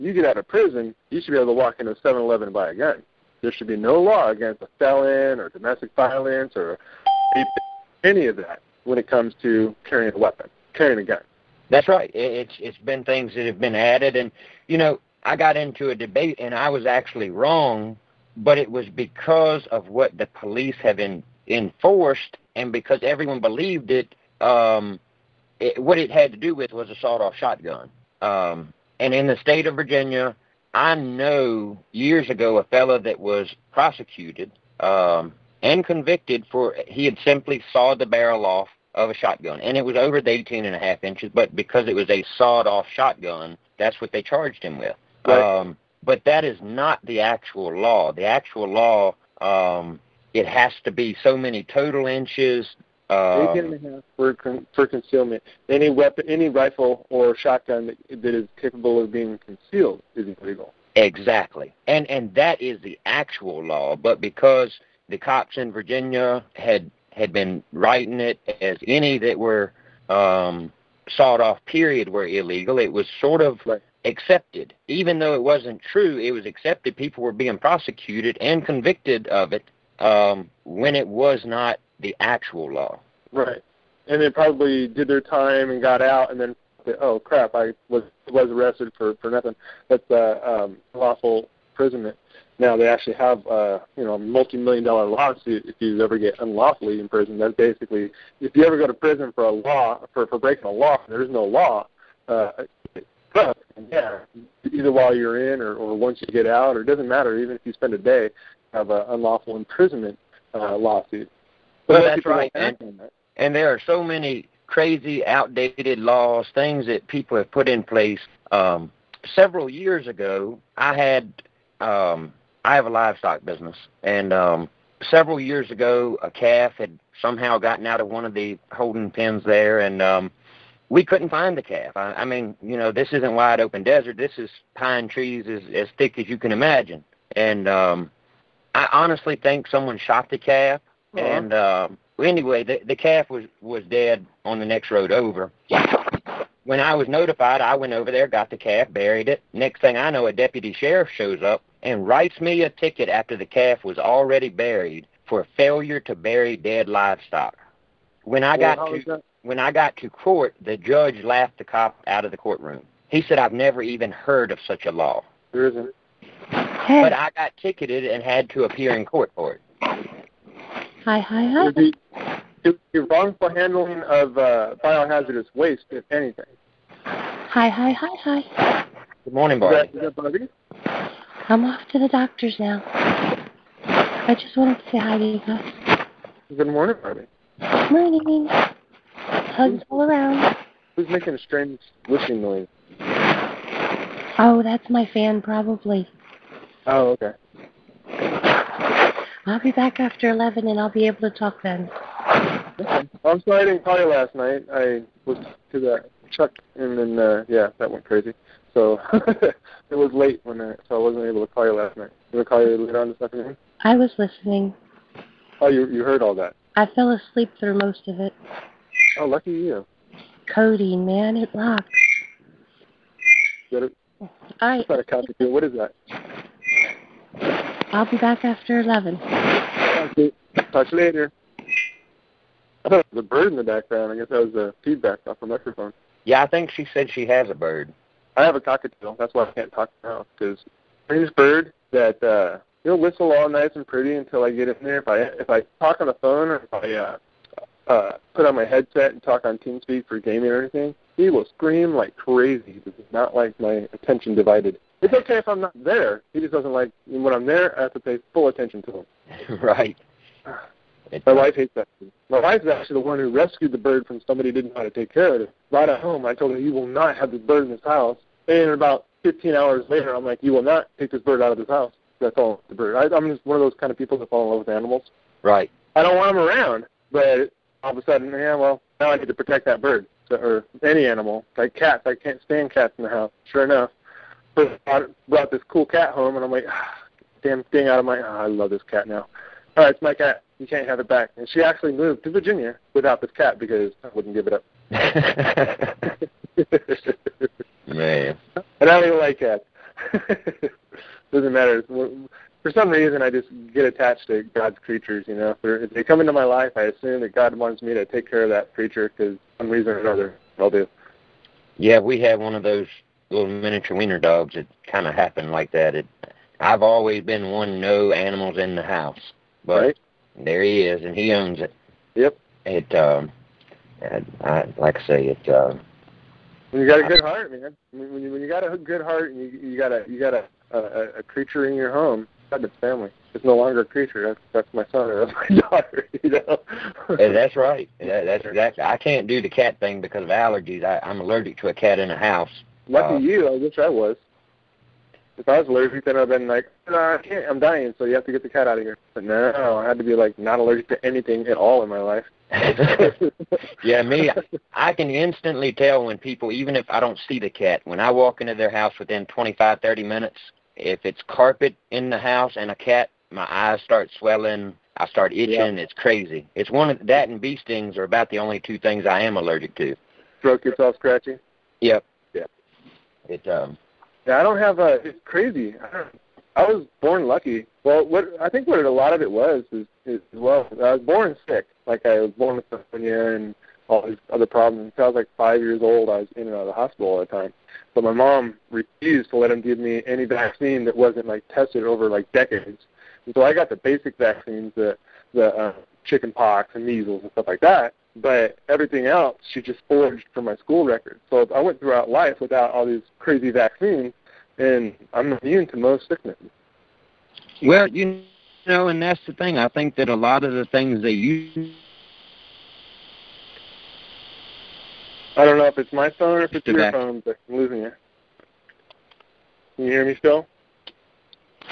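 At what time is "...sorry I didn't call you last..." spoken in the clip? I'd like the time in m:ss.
3:23.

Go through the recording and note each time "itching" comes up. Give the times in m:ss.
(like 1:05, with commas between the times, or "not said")
6:05.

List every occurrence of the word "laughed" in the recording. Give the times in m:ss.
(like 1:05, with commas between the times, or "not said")
2:41.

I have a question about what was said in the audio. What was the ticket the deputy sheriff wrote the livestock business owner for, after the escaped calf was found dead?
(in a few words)
Failure to bury dead livestock.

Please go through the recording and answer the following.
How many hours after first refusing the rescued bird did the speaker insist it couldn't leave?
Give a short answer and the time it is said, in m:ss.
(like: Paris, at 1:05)
15, at 4:29.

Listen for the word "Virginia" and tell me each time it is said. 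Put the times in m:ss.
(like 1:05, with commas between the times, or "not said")
0:29, 1:05, 4:52.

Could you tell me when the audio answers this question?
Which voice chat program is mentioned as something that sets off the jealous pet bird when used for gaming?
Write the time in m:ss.
4:09.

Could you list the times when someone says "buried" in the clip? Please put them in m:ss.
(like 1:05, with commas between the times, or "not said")
2:28, 2:34.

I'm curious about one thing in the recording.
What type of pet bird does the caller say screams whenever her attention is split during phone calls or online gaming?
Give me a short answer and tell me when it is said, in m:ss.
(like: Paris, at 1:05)
Cockatiel, at 3:58.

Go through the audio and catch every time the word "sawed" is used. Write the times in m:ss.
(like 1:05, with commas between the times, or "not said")
0:26, 0:37, 0:42, 1:11.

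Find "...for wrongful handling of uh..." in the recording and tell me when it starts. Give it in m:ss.
2:53.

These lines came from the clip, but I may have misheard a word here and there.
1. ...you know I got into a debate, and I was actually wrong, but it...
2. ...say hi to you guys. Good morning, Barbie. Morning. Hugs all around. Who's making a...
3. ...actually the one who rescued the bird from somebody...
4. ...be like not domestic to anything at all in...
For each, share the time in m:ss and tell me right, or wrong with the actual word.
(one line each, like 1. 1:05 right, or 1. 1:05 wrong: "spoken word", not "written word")
1. 0:14 right
2. 3:04 right
3. 4:22 right
4. 5:50 wrong: "allergic", not "domestic".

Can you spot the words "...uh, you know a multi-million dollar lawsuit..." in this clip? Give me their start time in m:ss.
1:33.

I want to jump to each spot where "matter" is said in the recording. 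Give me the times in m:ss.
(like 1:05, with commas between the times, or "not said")
1:47, 5:01.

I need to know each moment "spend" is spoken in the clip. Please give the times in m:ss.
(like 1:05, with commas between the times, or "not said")
1:47.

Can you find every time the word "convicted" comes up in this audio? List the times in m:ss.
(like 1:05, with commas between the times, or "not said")
0:35, 1:18.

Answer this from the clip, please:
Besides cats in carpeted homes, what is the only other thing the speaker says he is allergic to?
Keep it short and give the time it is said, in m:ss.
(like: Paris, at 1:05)
Bee stings, at 6:07.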